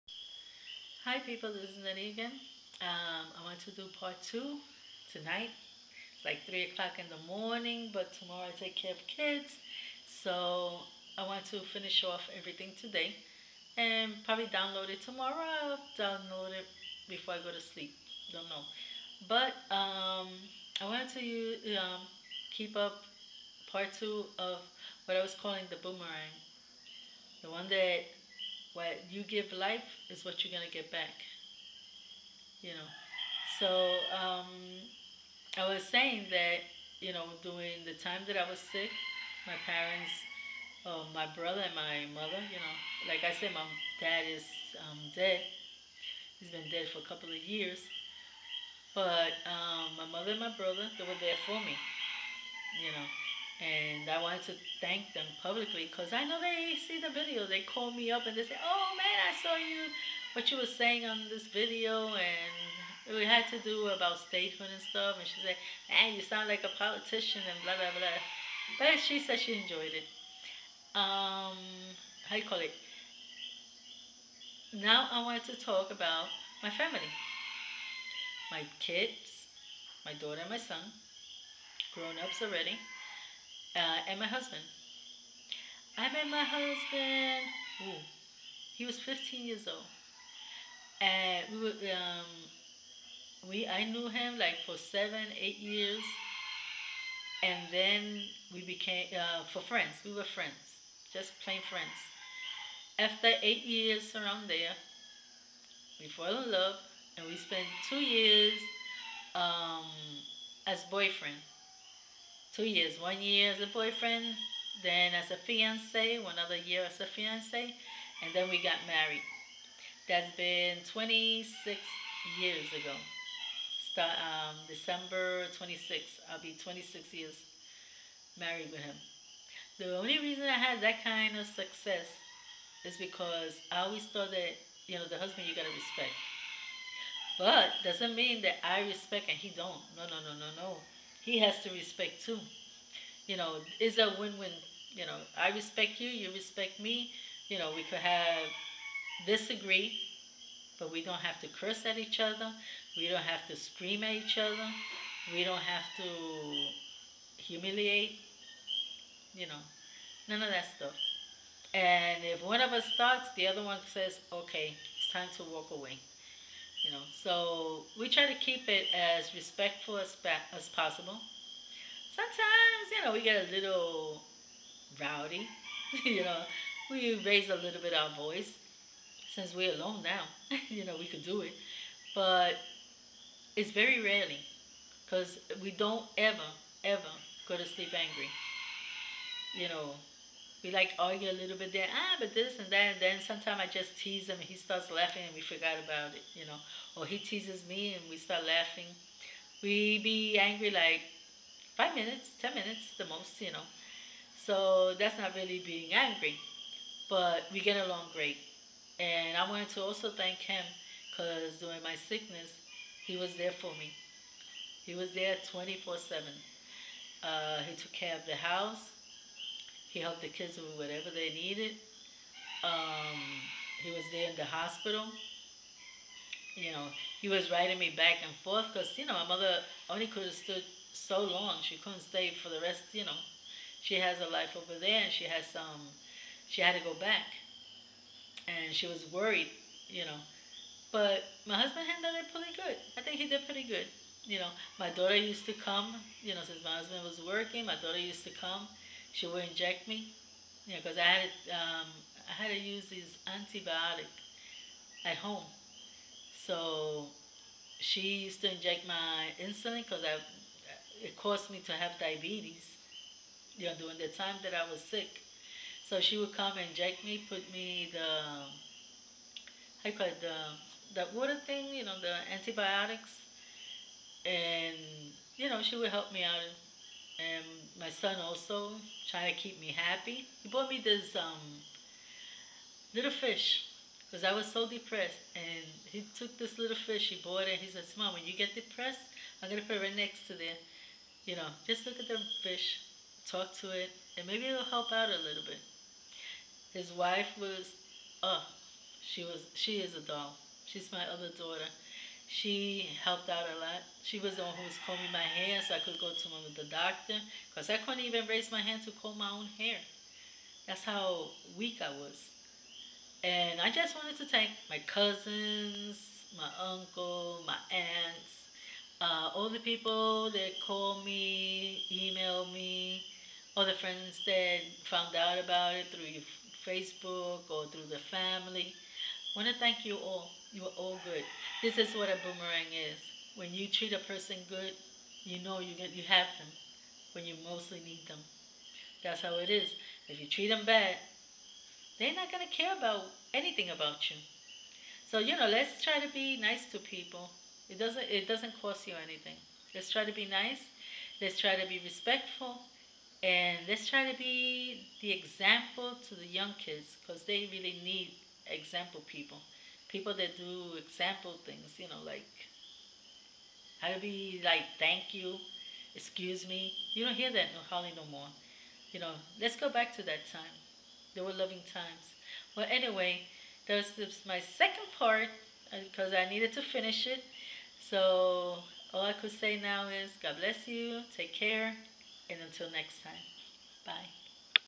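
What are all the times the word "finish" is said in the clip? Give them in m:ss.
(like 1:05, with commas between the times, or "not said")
0:11, 6:16.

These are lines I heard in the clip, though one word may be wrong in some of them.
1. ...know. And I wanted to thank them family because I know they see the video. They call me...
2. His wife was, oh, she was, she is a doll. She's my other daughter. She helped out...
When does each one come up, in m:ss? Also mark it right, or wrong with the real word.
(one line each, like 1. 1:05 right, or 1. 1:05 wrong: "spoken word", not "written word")
1. 0:52 wrong: "publicly", not "family"
2. 4:56 right.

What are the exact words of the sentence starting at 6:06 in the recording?
You don't hear that no hardly no more.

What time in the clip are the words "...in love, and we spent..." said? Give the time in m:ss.
1:46.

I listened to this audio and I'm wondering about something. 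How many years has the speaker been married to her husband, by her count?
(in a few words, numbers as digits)
26 years.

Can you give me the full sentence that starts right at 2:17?
But doesn't mean that I respect and he don't.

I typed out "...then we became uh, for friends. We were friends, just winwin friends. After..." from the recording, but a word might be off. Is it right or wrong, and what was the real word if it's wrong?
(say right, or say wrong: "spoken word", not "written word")
wrong: "plain", not "winwin".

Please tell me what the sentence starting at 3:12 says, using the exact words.
And then sometimes I just tease him and he starts laughing and we forgot about it, you know.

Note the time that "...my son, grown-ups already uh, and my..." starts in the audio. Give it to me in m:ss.
1:20.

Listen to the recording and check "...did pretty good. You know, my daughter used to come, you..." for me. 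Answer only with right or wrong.
right.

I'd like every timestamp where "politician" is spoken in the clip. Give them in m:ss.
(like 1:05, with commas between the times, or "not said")
1:06.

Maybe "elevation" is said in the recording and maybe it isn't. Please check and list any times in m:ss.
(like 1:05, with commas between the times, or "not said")
not said.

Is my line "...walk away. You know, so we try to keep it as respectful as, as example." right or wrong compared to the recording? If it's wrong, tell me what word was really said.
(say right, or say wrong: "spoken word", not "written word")
wrong: "possible", not "example".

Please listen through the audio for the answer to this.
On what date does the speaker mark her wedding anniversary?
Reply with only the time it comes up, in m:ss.
2:04.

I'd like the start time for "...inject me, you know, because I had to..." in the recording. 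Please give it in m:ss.
4:09.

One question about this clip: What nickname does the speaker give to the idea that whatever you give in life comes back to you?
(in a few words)
the boomerang.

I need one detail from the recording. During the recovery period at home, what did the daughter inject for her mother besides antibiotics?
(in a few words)
insulin.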